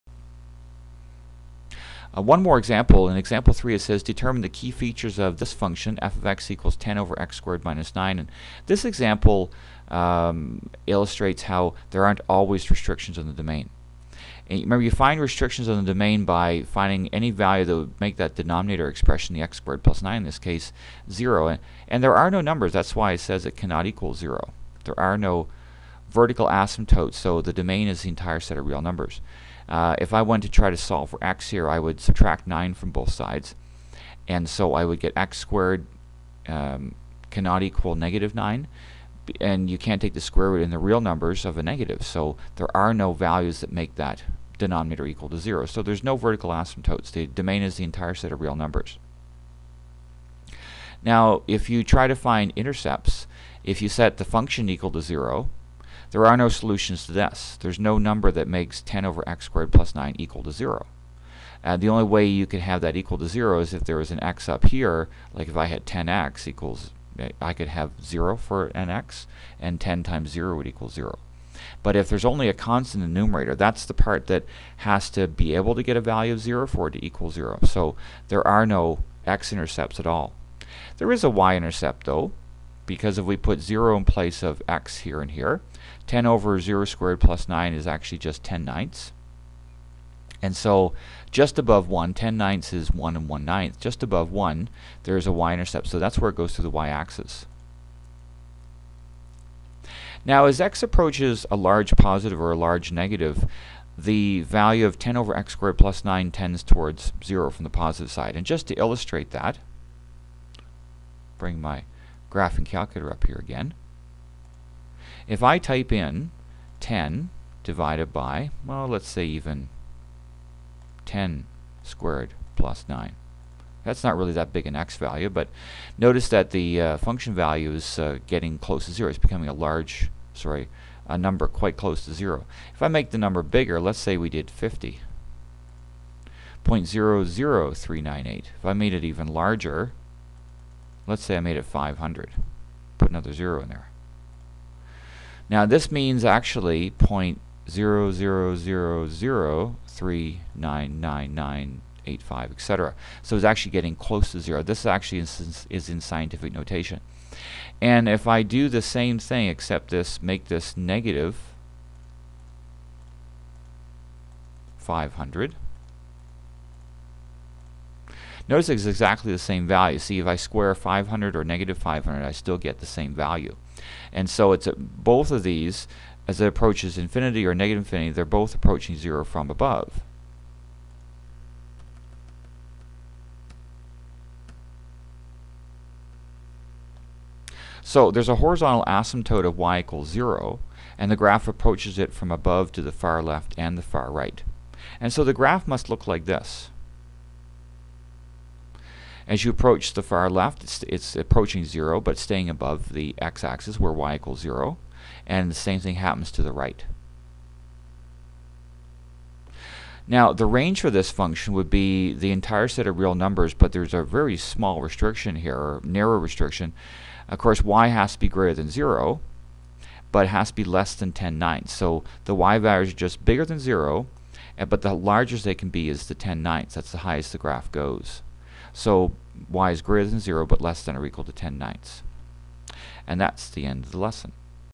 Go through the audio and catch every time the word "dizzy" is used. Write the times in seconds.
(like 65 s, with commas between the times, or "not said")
not said.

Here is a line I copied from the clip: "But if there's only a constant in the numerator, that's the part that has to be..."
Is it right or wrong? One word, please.
right.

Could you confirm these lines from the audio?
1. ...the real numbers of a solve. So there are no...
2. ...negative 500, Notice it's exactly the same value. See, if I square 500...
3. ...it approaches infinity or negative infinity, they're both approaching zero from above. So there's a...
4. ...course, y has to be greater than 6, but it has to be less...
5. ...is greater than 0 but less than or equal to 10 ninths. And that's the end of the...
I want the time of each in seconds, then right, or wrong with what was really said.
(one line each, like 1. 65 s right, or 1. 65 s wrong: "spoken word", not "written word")
1. 40 s wrong: "negative", not "solve"
2. 160 s right
3. 176 s right
4. 217 s wrong: "0", not "6"
5. 229 s right.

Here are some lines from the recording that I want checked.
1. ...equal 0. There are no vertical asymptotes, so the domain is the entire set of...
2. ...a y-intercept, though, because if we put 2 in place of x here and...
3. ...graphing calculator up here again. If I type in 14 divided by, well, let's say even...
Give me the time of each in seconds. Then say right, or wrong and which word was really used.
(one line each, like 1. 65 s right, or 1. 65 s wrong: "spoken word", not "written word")
1. 23 s right
2. 81 s wrong: "0", not "2"
3. 112 s wrong: "10", not "14".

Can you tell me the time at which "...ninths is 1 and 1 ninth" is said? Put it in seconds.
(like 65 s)
92 s.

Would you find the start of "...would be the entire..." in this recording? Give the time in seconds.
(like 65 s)
211 s.